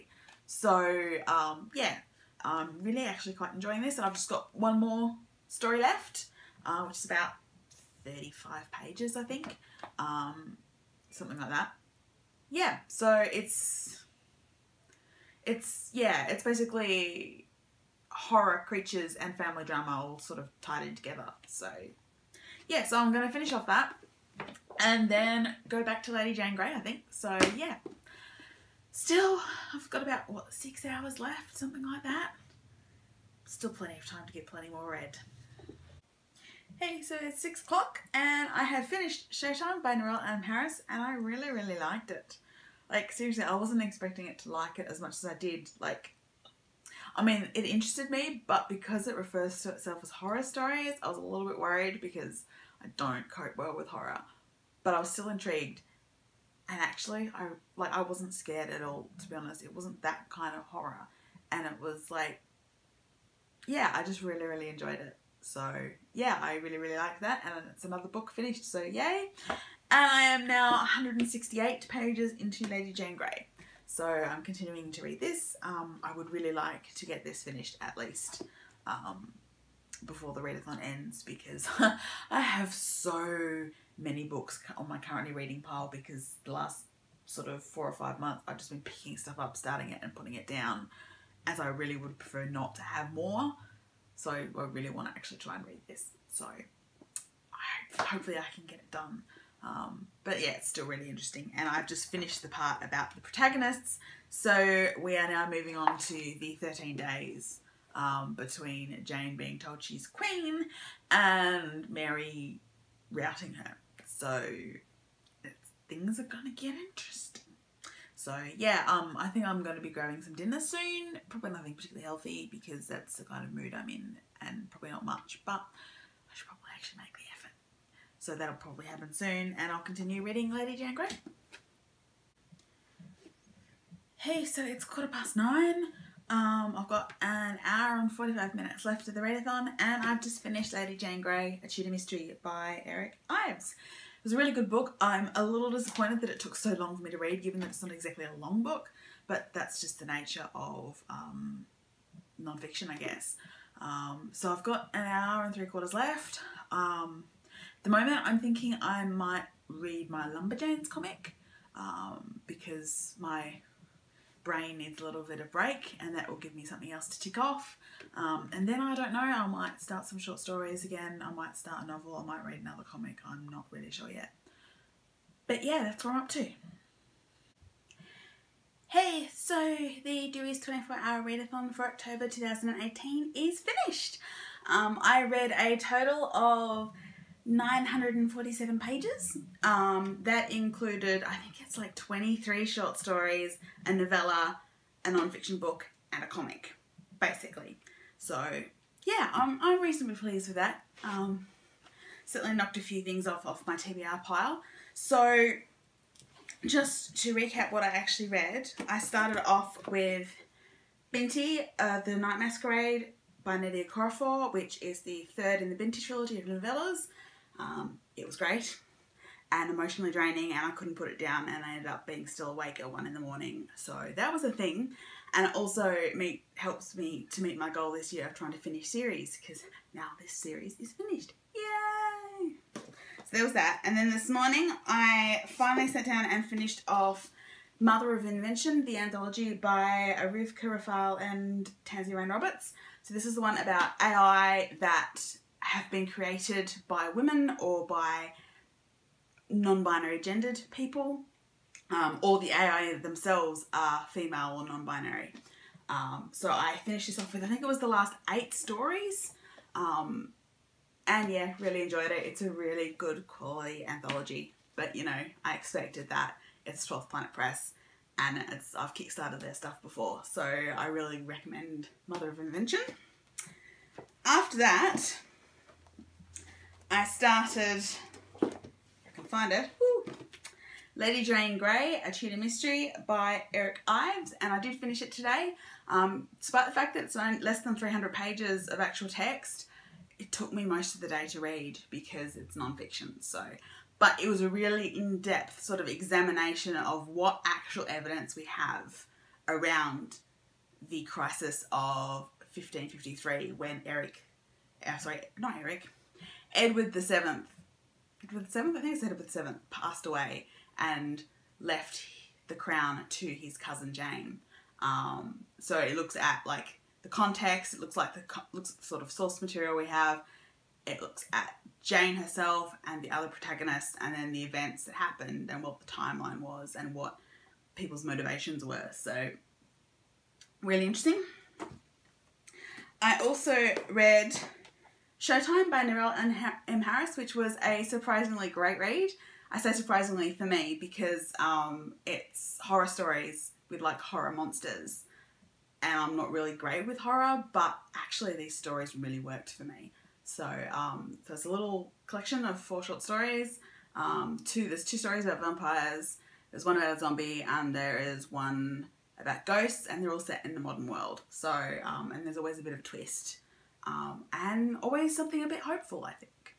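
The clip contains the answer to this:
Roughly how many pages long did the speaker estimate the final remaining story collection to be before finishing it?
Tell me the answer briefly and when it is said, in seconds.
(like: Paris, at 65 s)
35, at 8 s.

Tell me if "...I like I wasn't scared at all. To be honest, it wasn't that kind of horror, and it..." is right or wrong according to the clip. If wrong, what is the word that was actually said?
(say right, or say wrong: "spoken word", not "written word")
right.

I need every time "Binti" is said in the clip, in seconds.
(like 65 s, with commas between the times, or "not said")
211 s, 215 s.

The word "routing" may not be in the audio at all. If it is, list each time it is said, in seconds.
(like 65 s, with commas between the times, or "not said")
113 s.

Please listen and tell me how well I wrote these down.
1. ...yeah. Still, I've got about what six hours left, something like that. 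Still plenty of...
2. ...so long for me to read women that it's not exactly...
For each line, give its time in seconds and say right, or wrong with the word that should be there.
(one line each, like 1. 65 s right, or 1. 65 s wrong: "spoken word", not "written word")
1. 27 s right
2. 146 s wrong: "given", not "women".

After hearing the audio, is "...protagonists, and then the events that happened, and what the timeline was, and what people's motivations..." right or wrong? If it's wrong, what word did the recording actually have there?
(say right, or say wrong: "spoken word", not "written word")
right.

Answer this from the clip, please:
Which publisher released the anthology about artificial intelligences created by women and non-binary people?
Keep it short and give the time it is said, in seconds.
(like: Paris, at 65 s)
12th Planet Press, at 266 s.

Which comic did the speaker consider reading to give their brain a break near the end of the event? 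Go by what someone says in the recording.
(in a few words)
Lumberjanes.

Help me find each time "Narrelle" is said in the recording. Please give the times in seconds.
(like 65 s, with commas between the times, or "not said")
39 s, 335 s.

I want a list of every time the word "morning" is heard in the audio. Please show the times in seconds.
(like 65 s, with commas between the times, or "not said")
223 s, 234 s.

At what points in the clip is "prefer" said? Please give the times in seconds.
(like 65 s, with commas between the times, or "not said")
92 s.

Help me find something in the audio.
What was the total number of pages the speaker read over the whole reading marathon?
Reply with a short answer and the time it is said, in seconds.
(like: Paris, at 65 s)
947, at 187 s.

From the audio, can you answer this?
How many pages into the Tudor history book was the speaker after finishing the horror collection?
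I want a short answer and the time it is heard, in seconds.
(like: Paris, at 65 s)
168, at 70 s.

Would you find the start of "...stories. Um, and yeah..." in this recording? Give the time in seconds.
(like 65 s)
258 s.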